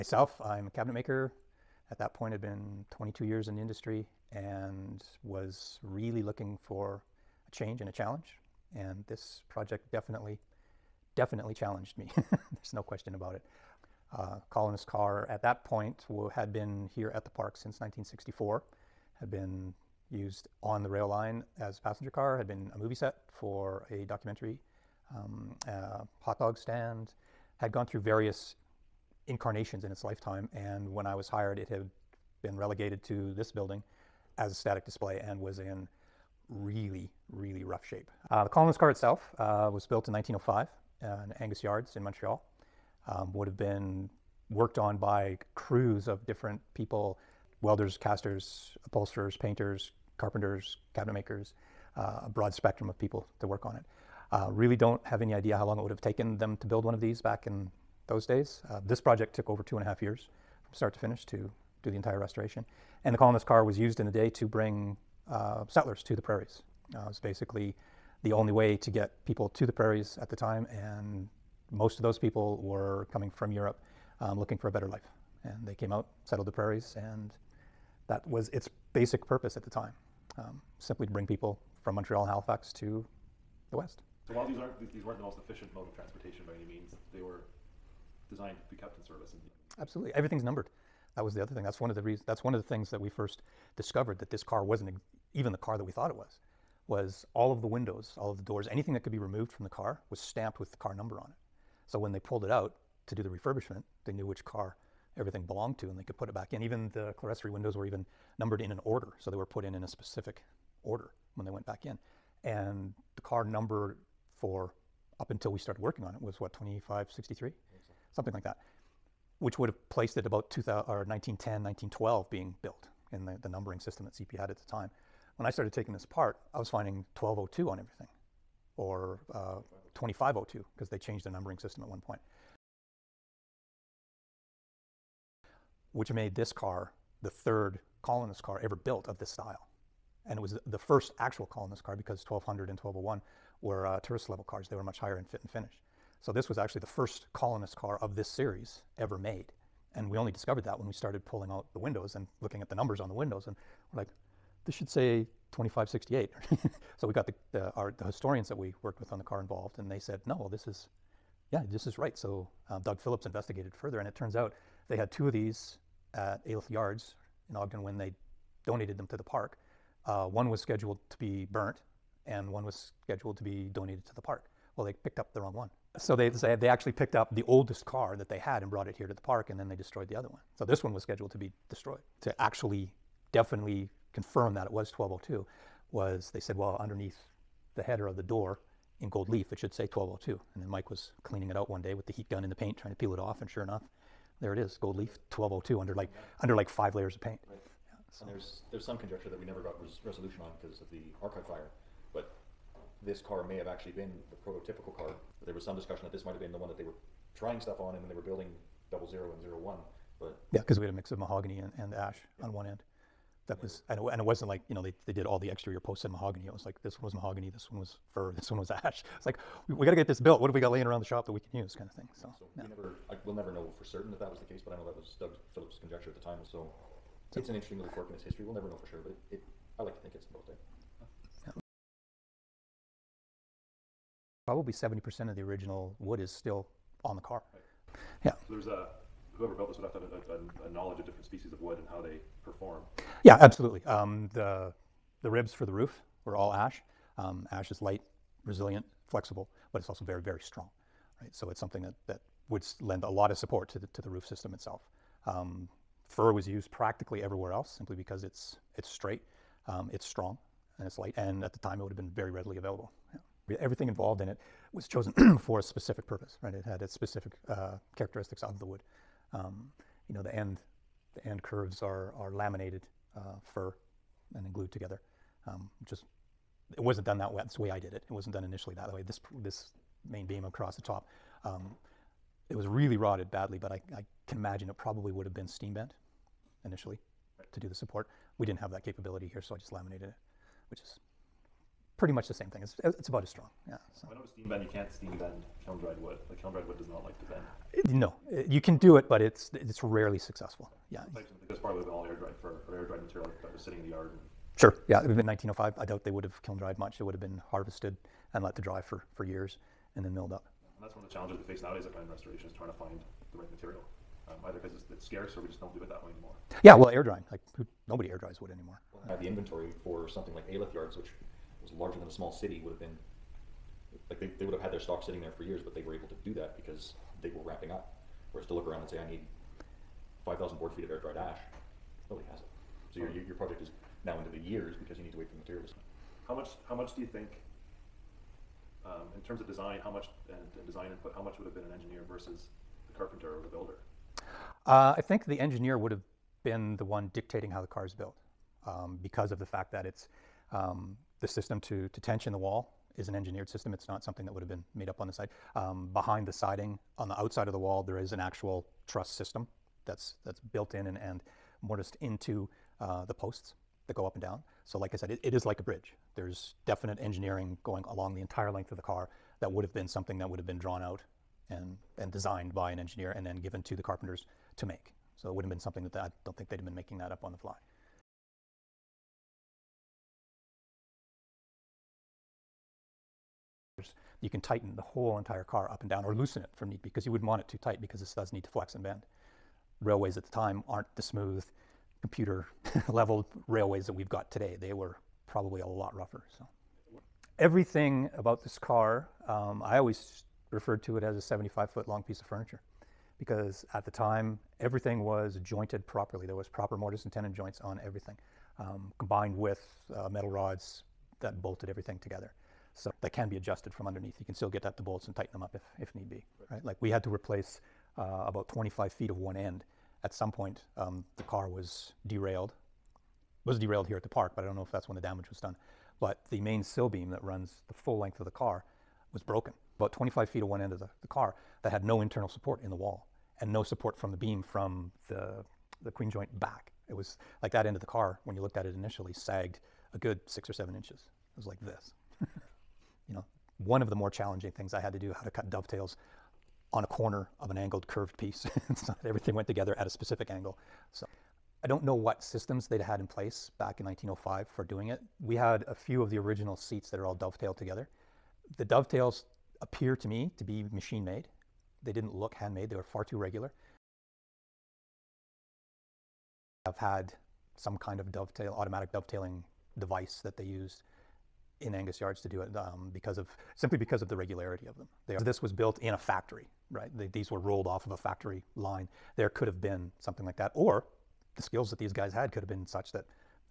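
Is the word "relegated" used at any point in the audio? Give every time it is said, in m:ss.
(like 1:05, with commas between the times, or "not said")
0:32.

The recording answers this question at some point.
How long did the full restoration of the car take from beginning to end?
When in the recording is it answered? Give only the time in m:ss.
0:59.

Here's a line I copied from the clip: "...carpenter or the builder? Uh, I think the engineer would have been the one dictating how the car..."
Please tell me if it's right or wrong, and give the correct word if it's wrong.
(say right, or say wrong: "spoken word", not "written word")
right.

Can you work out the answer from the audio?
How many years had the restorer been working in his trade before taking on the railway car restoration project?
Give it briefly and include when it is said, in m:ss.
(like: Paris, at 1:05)
22, at 0:02.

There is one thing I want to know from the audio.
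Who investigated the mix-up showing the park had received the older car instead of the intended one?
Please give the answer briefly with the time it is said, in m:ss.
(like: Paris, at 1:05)
Doug Phillips, at 2:42.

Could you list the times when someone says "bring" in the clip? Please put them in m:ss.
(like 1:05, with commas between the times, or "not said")
1:04, 1:21.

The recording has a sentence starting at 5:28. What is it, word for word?
Whereas to look around and say, I need 5,000 board feet of air dried ash, nobody has it.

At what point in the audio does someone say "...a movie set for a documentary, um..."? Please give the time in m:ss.
0:22.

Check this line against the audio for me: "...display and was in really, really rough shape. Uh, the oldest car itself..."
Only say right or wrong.
wrong.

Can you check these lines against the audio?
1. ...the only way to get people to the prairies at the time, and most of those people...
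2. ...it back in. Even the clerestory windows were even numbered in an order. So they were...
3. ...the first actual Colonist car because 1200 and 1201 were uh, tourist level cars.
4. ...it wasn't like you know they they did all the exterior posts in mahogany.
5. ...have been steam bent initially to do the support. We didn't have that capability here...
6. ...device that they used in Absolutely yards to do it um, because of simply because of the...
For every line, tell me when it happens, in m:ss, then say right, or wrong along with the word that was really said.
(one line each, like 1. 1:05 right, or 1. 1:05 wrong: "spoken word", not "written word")
1. 1:08 right
2. 1:46 right
3. 2:20 right
4. 3:34 right
5. 4:45 right
6. 7:49 wrong: "Angus", not "Absolutely".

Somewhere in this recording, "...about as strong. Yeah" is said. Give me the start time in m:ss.
4:53.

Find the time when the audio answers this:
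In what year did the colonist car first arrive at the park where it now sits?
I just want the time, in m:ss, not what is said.
0:17.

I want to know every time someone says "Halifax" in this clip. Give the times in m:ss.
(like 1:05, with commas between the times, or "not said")
1:22.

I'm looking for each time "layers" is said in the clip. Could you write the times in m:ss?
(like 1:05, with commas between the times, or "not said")
3:16.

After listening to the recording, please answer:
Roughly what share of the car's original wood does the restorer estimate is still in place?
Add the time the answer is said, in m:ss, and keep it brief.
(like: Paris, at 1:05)
70 percent, at 3:54.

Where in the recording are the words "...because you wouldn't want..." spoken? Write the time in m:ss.
6:26.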